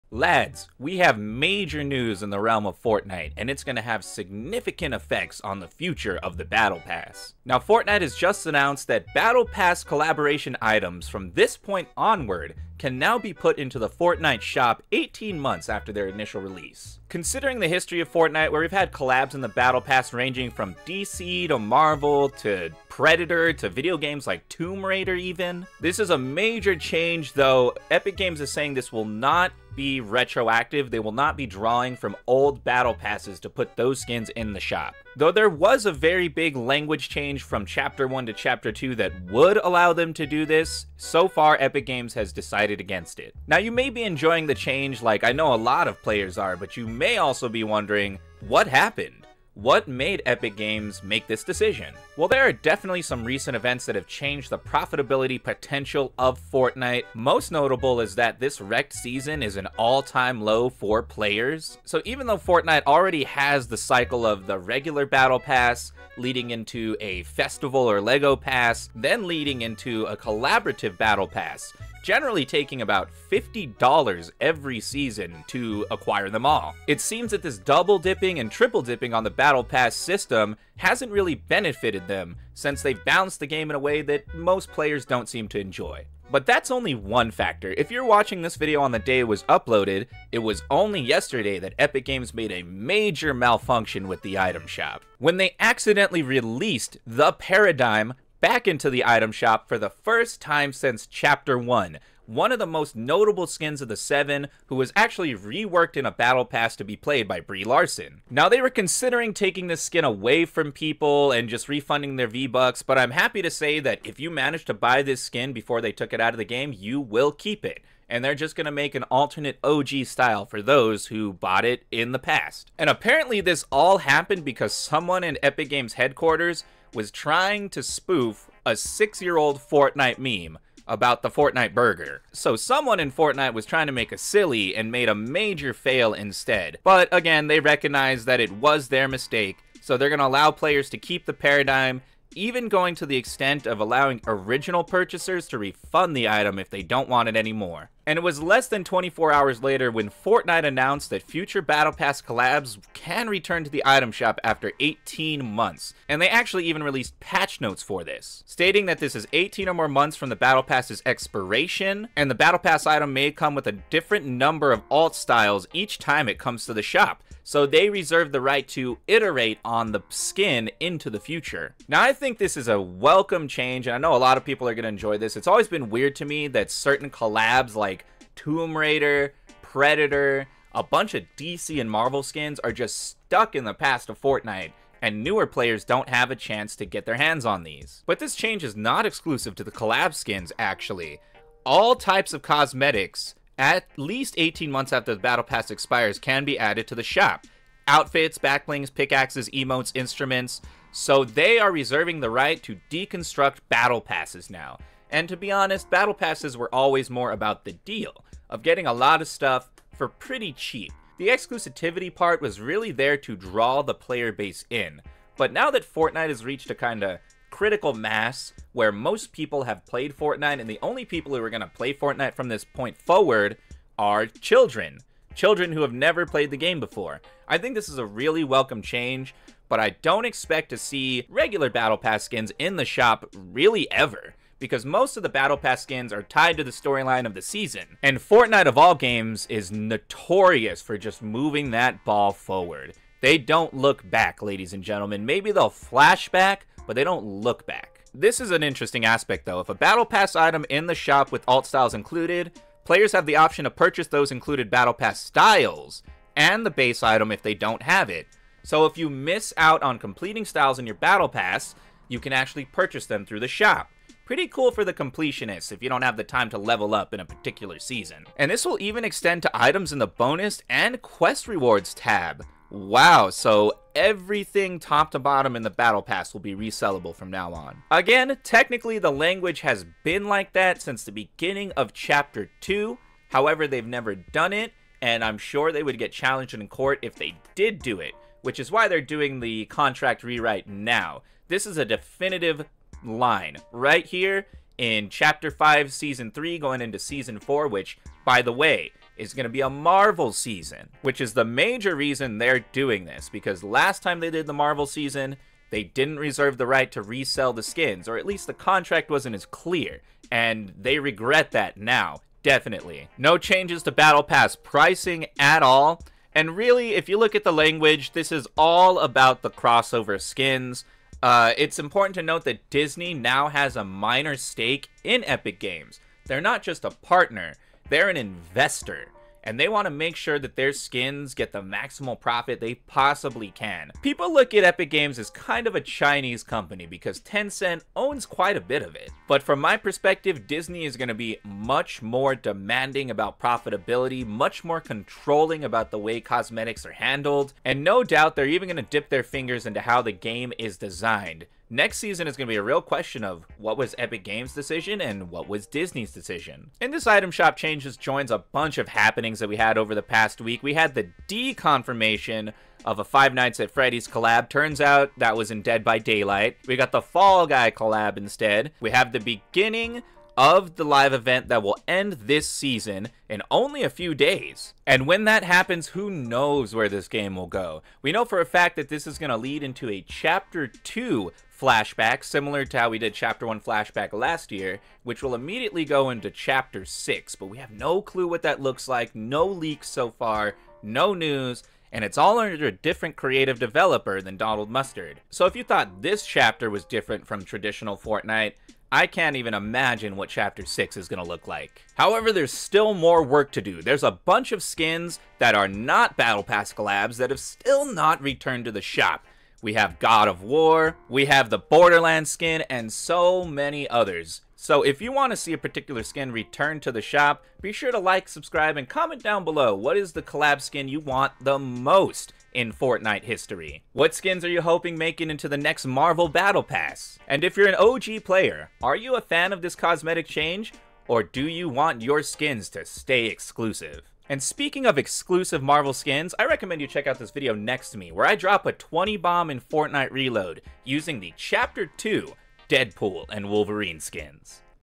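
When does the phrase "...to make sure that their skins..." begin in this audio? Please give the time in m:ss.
5:29.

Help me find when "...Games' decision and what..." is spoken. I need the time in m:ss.
5:54.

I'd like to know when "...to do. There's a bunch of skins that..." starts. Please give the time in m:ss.
6:43.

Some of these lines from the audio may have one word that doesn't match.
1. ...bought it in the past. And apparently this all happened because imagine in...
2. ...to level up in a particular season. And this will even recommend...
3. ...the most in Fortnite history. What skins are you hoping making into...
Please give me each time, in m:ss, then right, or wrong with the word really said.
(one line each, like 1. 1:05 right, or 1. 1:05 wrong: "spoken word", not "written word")
1. 2:01 wrong: "someone", not "imagine"
2. 4:26 wrong: "extend", not "recommend"
3. 7:01 right.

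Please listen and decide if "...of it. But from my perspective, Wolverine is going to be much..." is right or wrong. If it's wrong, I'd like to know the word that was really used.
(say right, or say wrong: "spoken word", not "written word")
wrong: "Disney", not "Wolverine".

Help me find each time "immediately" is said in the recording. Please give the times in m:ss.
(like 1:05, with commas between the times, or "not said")
6:25.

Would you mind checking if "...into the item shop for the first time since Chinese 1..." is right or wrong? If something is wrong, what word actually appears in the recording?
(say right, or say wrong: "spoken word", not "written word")
wrong: "Chapter", not "Chinese".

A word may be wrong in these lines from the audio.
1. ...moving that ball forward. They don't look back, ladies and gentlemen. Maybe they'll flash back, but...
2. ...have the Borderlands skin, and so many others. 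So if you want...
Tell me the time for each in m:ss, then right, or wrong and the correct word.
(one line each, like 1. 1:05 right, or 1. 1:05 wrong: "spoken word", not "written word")
1. 4:01 right
2. 6:51 right.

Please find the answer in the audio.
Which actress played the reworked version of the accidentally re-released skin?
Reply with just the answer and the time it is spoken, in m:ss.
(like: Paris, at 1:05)
Brie Larson, at 1:47.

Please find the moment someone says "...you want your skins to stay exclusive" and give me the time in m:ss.
7:11.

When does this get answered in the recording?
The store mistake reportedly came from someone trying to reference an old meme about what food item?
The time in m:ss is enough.
2:11.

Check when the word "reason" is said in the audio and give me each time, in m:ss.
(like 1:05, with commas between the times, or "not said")
5:01.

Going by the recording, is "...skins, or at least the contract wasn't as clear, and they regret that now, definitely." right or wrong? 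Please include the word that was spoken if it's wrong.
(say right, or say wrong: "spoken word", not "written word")
right.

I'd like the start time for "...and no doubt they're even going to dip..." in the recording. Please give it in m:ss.
5:47.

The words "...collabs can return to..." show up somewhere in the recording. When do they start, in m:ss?
2:32.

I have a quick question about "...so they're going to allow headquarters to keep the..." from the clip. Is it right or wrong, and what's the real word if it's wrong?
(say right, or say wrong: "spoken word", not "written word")
wrong: "players", not "headquarters".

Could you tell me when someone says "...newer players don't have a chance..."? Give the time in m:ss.
3:05.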